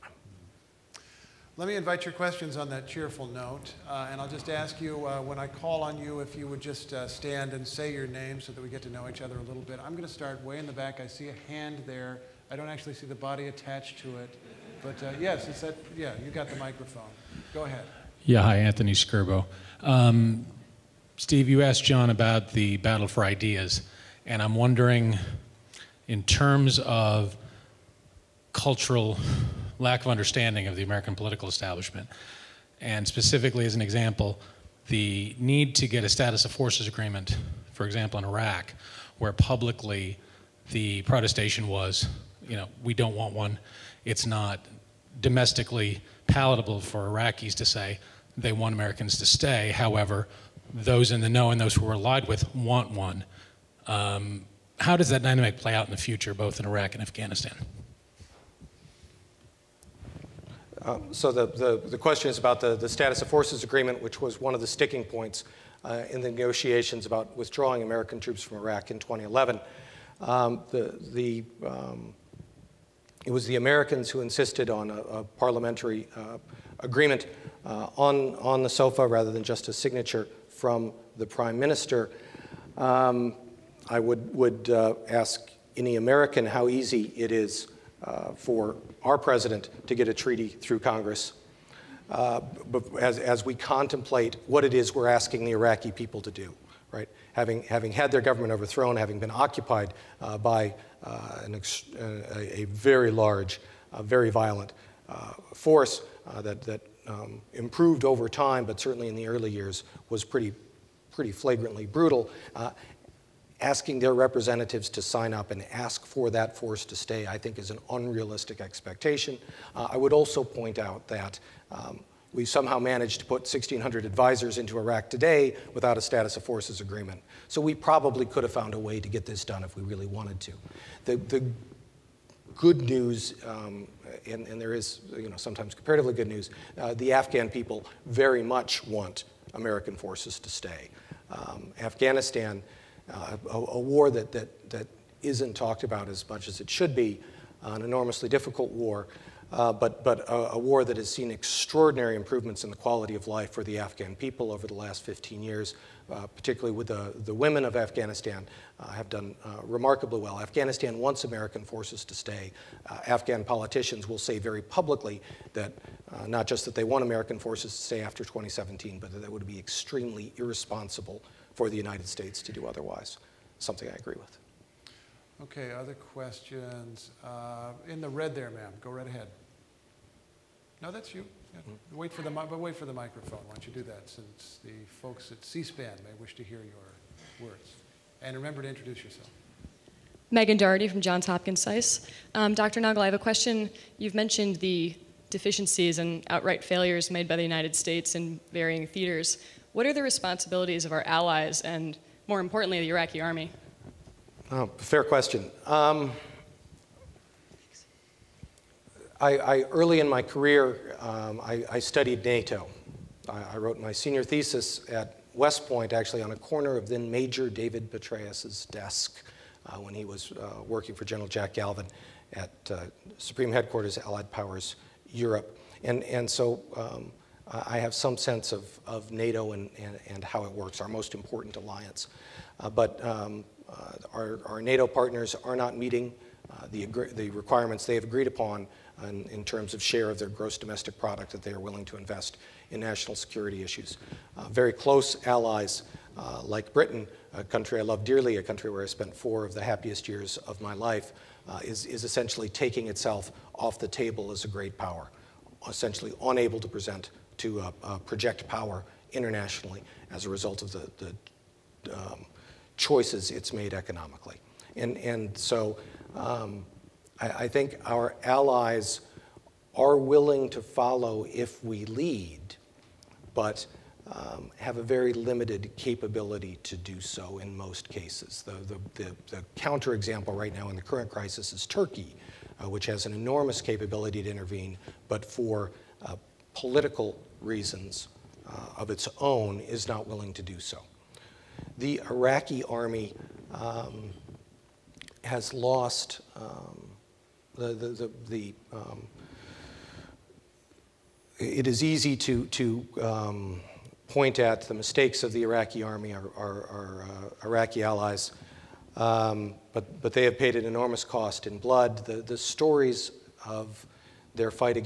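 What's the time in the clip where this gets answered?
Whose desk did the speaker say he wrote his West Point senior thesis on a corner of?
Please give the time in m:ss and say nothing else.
3:37.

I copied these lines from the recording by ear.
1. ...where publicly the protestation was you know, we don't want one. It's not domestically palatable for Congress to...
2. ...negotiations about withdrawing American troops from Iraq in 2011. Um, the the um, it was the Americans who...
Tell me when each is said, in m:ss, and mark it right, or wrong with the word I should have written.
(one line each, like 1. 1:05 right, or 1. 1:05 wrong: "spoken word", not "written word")
1. 0:39 wrong: "Iraqis", not "Congress"
2. 1:06 right.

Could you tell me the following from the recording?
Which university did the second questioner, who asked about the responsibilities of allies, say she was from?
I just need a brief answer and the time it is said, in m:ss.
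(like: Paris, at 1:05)
Johns Hopkins SAIS, at 3:10.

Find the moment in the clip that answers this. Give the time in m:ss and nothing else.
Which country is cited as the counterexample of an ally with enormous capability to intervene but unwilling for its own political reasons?
4:41.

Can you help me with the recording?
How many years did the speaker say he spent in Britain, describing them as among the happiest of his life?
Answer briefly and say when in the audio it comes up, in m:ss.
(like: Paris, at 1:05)
4, at 4:09.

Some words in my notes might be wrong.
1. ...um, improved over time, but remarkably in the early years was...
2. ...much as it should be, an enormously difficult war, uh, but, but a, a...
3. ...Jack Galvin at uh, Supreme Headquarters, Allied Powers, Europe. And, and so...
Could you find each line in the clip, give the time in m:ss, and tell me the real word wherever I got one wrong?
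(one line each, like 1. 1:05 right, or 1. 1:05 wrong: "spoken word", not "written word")
1. 1:47 wrong: "certainly", not "remarkably"
2. 2:26 right
3. 3:41 right.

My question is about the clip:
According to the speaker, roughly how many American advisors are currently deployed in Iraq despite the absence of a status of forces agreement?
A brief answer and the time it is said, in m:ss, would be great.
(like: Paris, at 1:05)
1,600, at 2:03.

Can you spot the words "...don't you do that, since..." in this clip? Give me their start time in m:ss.
3:03.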